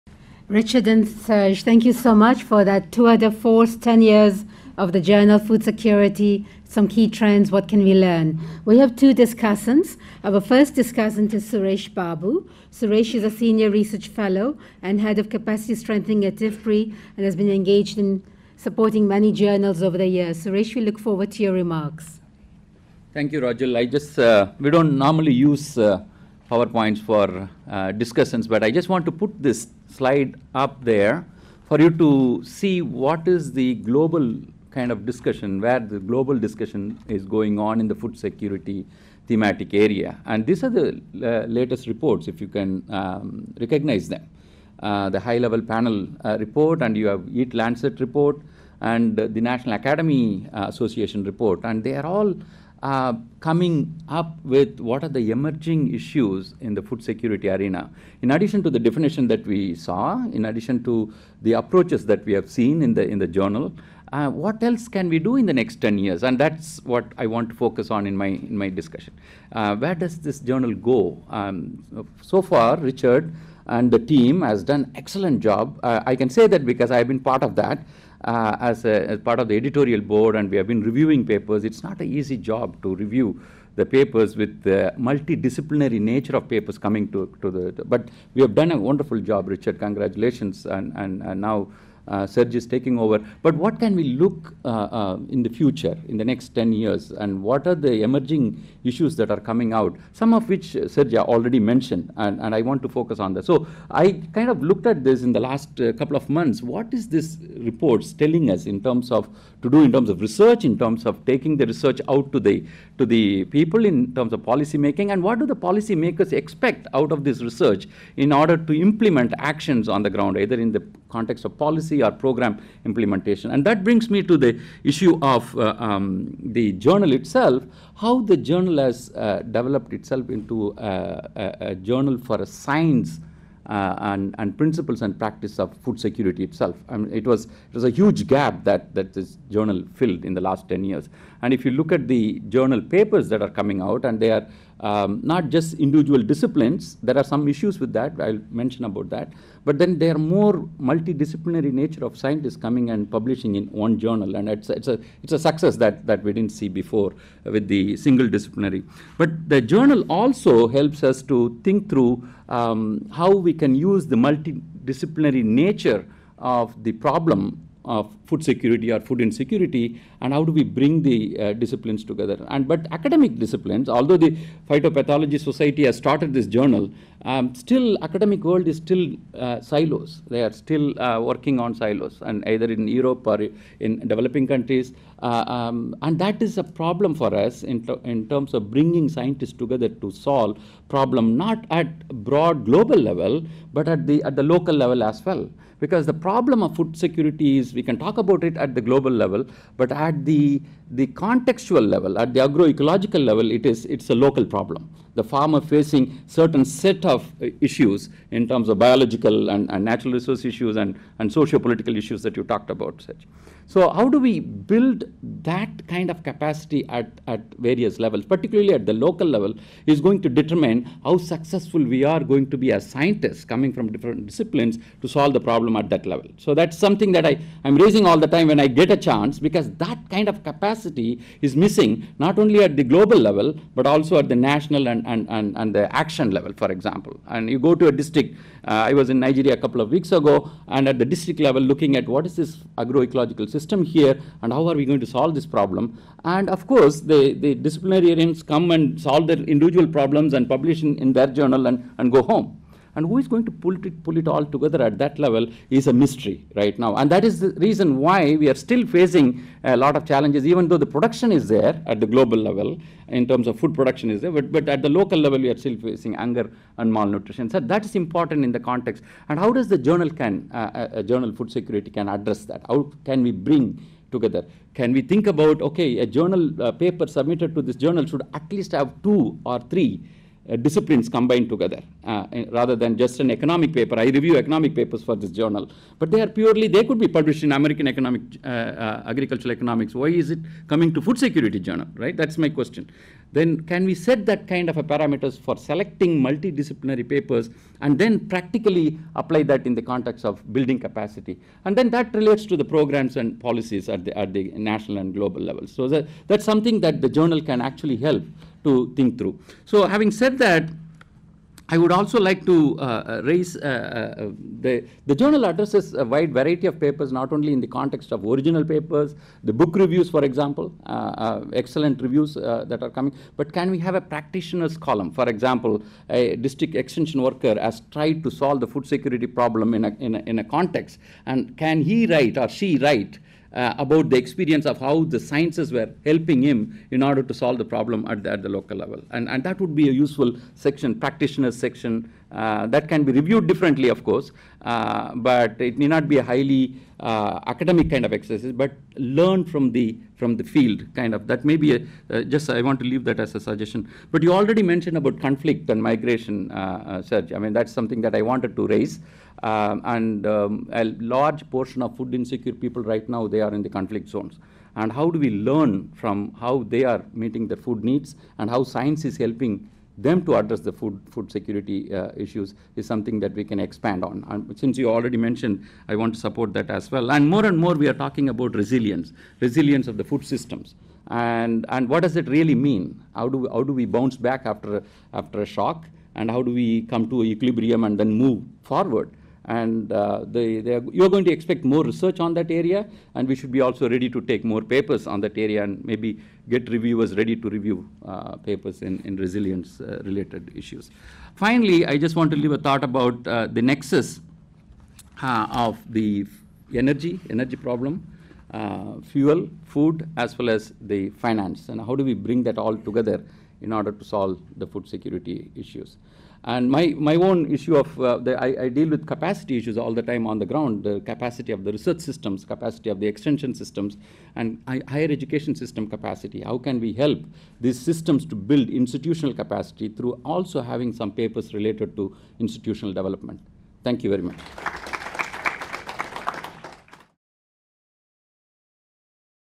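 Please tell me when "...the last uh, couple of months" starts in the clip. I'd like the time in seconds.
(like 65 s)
105 s.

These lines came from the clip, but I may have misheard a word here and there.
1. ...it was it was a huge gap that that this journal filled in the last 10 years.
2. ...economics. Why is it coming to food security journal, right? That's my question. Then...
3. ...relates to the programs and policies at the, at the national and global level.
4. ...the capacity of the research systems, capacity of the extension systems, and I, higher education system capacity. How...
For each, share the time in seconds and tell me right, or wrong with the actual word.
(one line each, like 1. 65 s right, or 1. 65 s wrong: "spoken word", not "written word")
1. 137 s right
2. 289 s right
3. 302 s right
4. 420 s right.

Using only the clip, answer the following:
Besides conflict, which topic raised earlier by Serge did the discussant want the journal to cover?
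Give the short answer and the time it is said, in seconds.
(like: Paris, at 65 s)
Migration, at 355 s.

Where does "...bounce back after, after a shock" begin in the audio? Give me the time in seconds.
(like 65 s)
383 s.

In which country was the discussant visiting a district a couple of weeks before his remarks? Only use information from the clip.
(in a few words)
Nigeria.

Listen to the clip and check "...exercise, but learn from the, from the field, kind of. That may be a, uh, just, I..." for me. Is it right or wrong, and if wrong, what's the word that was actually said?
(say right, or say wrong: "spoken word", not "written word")
right.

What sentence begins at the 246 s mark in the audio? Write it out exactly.
And of course, the, the disciplinarians come and solve their individual problems and publish in, in their journal and, and go home.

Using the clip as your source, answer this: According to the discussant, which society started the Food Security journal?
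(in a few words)
Phytopathology society.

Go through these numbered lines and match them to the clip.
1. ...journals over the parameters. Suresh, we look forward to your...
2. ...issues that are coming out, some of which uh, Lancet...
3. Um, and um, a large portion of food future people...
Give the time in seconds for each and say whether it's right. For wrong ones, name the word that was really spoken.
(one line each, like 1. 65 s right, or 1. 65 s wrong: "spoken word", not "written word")
1. 19 s wrong: "years", not "parameters"
2. 98 s wrong: "Serge", not "Lancet"
3. 359 s wrong: "insecure", not "future".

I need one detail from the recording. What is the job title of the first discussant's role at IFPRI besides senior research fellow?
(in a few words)
Head of capacity strengthening.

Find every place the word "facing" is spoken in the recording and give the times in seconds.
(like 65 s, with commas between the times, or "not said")
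205 s, 258 s, 265 s.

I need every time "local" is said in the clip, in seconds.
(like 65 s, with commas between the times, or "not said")
194 s, 204 s, 218 s, 264 s, 338 s.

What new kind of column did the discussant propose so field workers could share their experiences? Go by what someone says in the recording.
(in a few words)
Practitioner's column.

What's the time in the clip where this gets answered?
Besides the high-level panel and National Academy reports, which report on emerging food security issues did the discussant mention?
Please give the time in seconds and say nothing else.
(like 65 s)
47 s.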